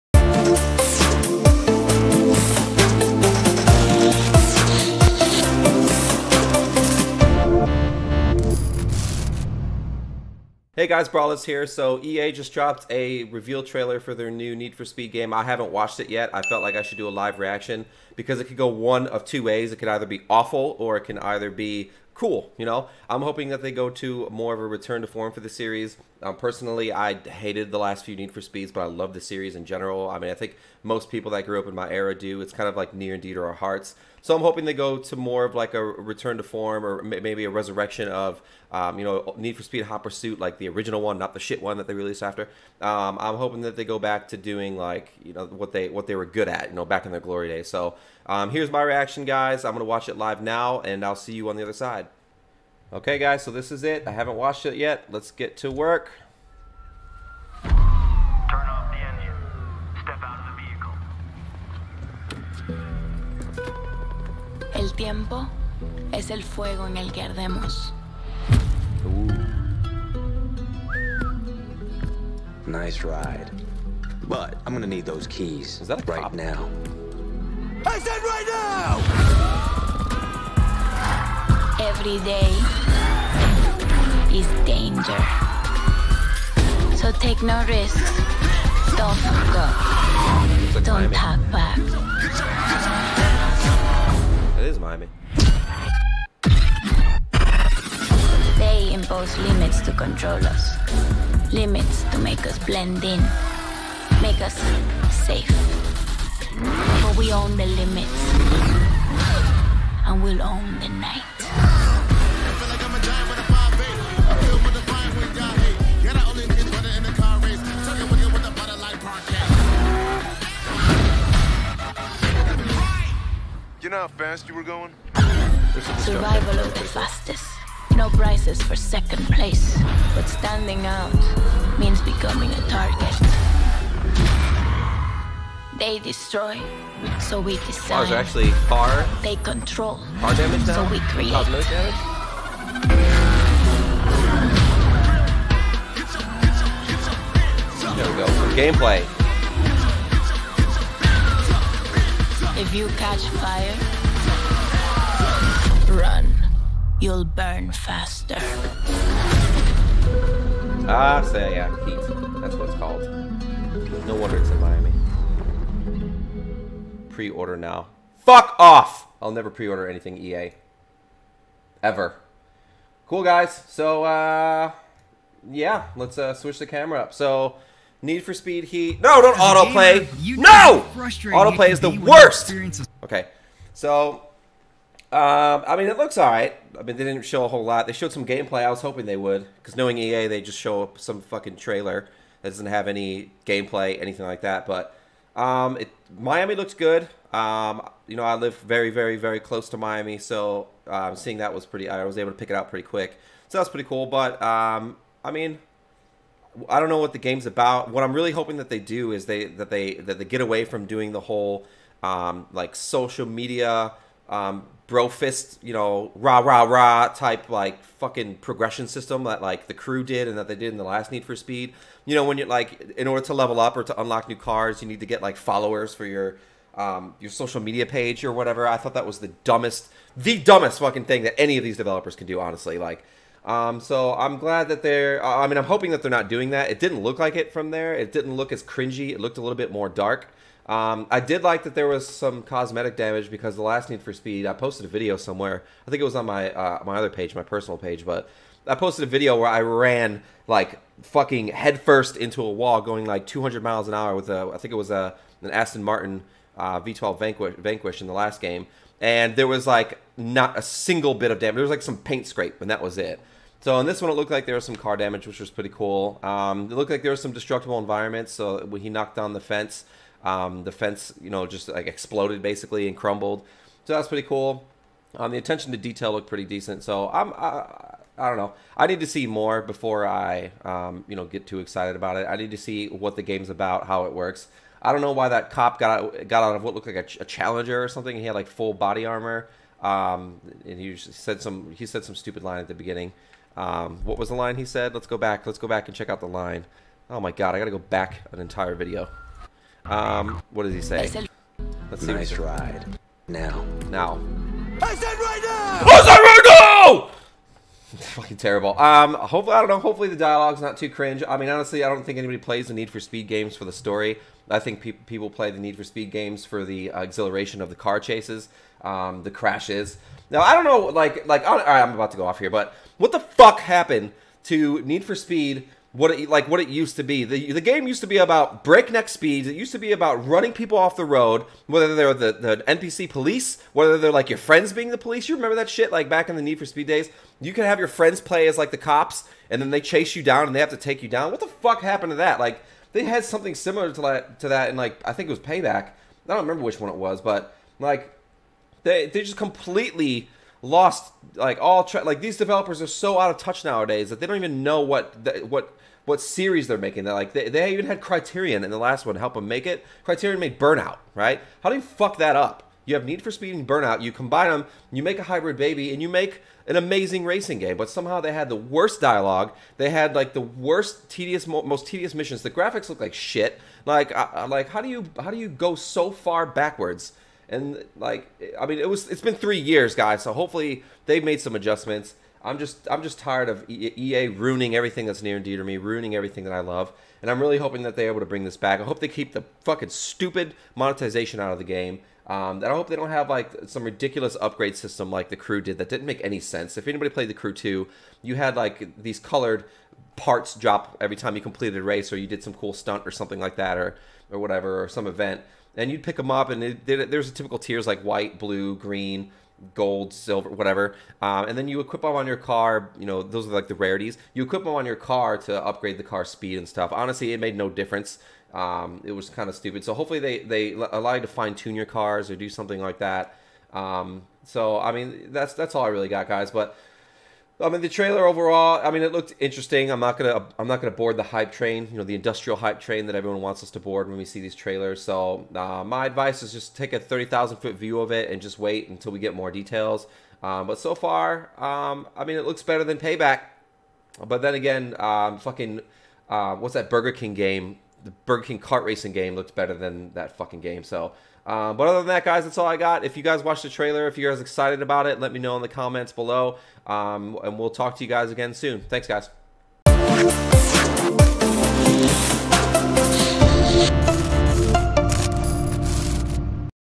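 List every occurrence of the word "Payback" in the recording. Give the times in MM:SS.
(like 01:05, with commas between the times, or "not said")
05:45, 07:22.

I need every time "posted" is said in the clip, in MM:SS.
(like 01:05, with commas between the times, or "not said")
04:04, 04:08.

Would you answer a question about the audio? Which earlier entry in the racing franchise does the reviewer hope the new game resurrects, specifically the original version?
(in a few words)
Hot Pursuit.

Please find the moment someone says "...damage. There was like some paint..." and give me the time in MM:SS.
04:21.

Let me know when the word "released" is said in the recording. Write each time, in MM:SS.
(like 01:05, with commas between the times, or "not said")
00:41.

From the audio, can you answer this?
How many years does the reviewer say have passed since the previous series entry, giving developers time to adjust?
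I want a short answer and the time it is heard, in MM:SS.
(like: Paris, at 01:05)
3, at 06:19.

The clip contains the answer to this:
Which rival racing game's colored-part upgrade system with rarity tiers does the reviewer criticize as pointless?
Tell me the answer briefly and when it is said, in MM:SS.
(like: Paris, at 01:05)
The Crew 2, at 06:37.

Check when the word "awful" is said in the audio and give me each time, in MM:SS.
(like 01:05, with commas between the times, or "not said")
00:20.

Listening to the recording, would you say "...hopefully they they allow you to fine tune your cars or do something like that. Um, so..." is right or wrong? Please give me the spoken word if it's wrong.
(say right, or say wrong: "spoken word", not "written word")
right.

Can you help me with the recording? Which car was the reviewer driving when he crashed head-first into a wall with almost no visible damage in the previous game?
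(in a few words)
Aston Martin V12 Vanquish.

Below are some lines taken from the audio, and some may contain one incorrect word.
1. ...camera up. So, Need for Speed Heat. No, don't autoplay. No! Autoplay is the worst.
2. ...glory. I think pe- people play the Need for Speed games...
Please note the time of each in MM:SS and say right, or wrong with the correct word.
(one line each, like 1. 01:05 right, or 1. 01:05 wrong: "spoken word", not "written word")
1. 02:56 right
2. 05:13 wrong: "story", not "glory".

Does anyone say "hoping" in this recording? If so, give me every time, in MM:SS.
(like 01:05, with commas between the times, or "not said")
00:23, 00:34, 00:43, 03:08, 03:28, 03:55, 06:27.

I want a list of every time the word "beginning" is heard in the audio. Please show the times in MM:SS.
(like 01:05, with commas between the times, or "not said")
04:52.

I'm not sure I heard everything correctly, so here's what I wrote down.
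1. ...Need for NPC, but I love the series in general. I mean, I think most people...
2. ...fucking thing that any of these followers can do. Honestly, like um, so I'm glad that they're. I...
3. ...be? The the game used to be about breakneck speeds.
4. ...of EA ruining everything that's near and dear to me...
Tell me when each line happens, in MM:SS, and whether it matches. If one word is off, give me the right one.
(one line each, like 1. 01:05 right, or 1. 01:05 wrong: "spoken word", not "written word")
1. 00:28 wrong: "Speeds", not "NPC"
2. 03:50 wrong: "developers", not "followers"
3. 05:27 right
4. 06:23 right.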